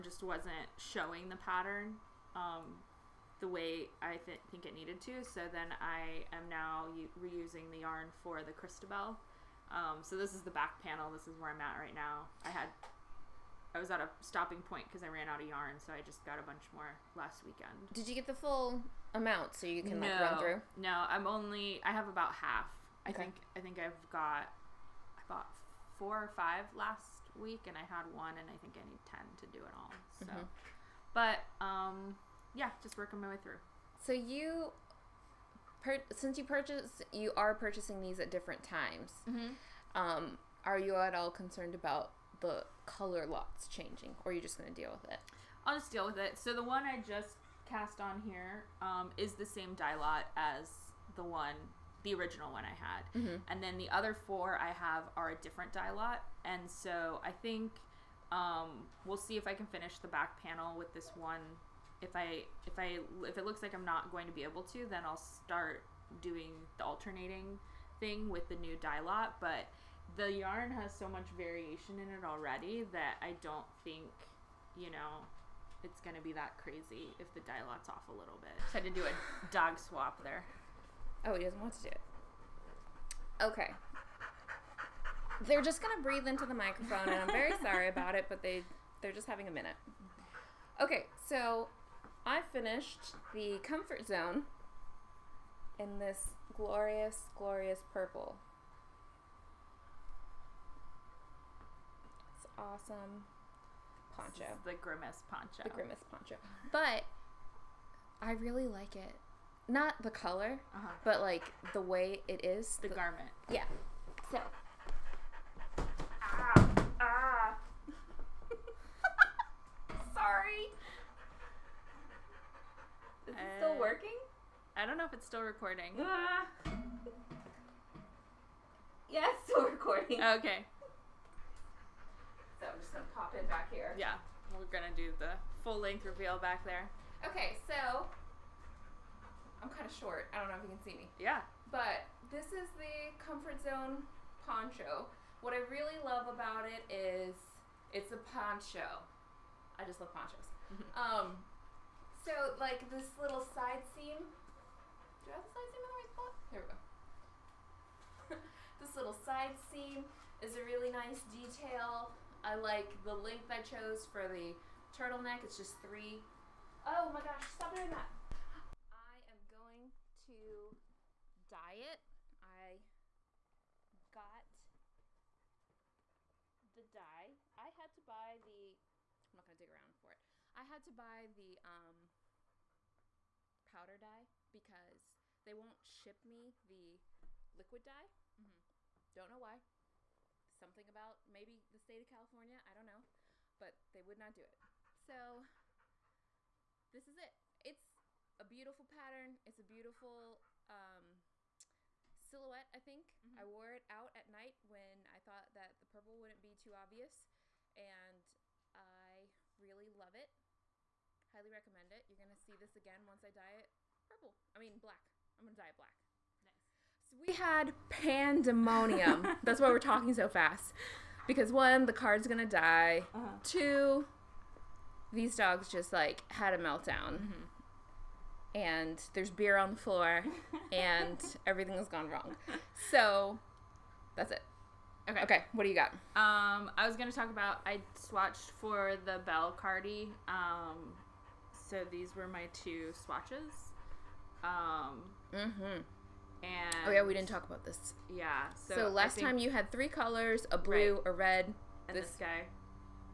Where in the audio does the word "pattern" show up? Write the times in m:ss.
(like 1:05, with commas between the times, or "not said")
0:01, 3:18.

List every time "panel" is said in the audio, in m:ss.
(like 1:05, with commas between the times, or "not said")
0:10, 1:00.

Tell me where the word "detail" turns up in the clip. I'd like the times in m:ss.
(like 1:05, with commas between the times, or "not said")
2:41.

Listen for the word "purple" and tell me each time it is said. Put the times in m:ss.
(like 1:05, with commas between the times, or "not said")
1:37, 3:25, 3:34.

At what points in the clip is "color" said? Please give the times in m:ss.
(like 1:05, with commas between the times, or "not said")
0:42, 1:50, 4:09.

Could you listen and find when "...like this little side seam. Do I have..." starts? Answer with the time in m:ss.
2:32.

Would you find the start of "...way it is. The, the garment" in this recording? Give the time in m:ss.
1:51.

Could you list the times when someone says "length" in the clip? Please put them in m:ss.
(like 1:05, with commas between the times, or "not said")
2:15, 2:43.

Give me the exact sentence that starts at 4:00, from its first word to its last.
Um, so these were my two swatches.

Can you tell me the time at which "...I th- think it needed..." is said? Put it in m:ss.
0:03.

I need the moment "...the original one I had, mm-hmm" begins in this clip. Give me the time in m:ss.
0:52.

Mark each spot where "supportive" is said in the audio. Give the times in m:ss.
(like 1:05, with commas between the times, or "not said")
not said.